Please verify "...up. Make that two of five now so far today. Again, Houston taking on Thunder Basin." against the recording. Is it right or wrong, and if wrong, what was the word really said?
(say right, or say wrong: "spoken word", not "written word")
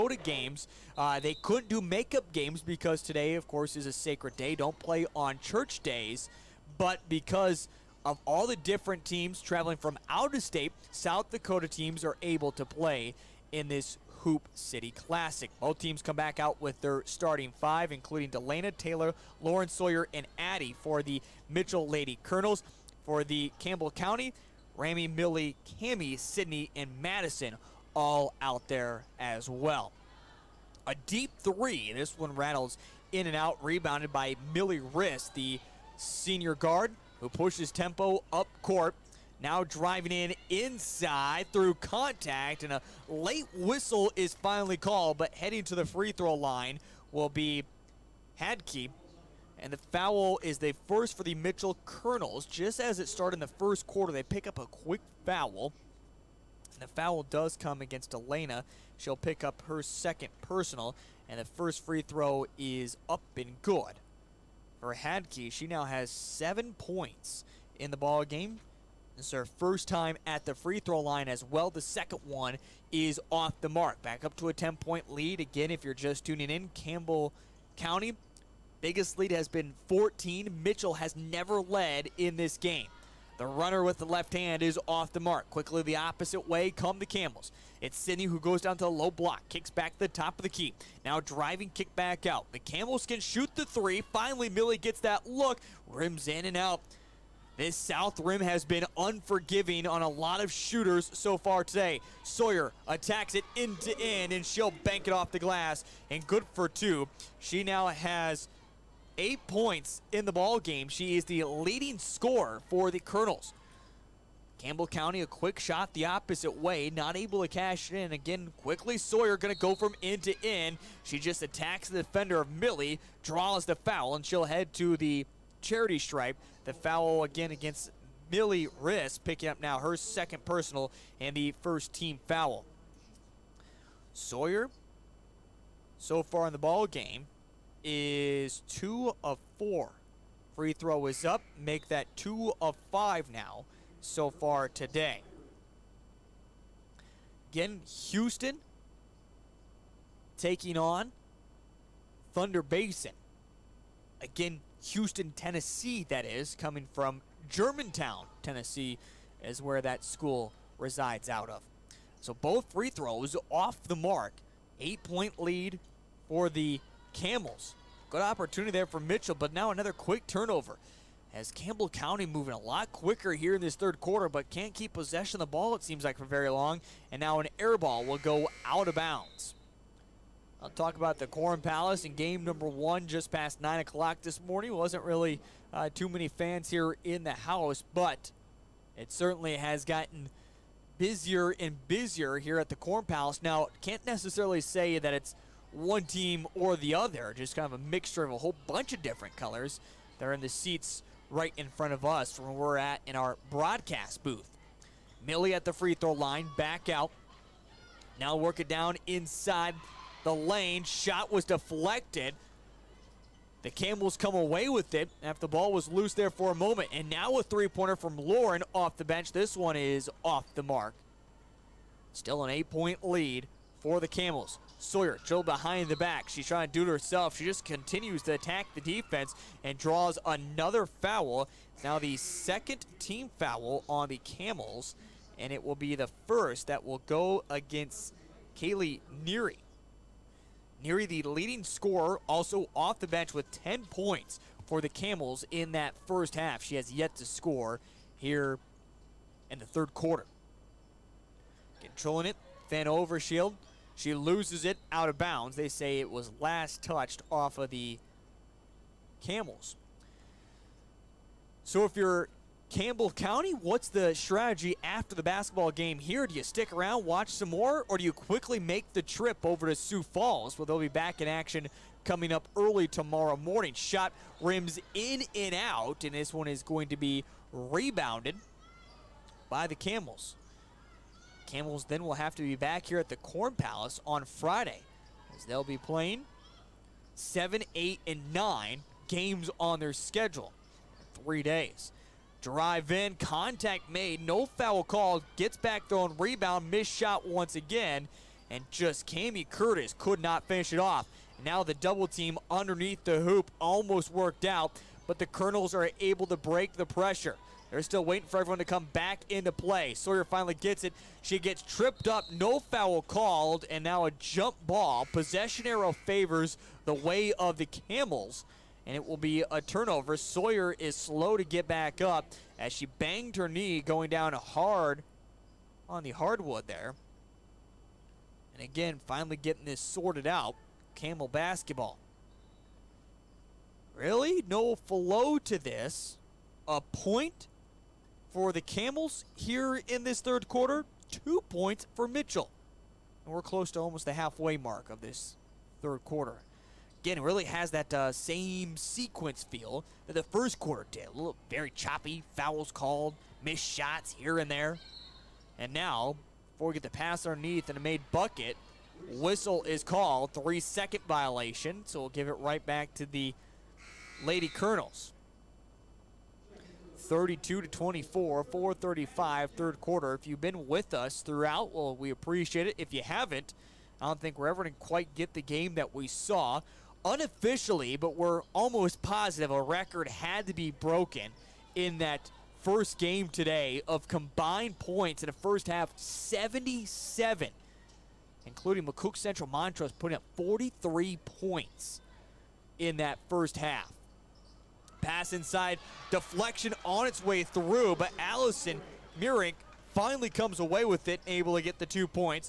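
right.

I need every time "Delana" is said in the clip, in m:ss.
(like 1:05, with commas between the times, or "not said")
0:18.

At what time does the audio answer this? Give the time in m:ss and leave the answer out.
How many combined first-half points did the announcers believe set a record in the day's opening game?
6:25.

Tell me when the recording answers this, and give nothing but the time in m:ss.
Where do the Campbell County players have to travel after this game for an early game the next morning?
4:29.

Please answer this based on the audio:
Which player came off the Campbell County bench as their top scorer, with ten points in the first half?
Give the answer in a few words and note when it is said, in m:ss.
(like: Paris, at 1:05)
Kaylee Neary, at 3:58.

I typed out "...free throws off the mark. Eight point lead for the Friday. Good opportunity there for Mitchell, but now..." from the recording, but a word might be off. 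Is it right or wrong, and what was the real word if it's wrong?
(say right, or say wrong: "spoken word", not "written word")
wrong: "Camels", not "Friday".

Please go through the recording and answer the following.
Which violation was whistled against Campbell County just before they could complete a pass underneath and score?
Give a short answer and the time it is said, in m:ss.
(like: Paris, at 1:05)
Three-second violation, at 6:00.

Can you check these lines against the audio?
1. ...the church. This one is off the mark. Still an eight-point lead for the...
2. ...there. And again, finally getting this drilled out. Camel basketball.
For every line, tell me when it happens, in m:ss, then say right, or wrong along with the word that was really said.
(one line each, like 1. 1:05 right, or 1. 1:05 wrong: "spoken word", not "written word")
1. 3:38 wrong: "bench", not "church"
2. 5:26 wrong: "sorted", not "drilled".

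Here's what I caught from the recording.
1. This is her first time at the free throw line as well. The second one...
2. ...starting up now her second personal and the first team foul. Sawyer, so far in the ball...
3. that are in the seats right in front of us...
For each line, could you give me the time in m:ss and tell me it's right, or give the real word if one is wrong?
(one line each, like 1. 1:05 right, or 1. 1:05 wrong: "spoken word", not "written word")
1. 1:09 right
2. 2:09 wrong: "picking", not "starting"
3. 3:20 right.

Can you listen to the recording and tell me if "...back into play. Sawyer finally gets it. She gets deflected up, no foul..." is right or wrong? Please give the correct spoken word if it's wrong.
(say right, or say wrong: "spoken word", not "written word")
wrong: "tripped", not "deflected".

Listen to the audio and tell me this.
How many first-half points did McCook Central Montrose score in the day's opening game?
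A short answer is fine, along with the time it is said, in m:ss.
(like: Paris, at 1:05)
43, at 6:30.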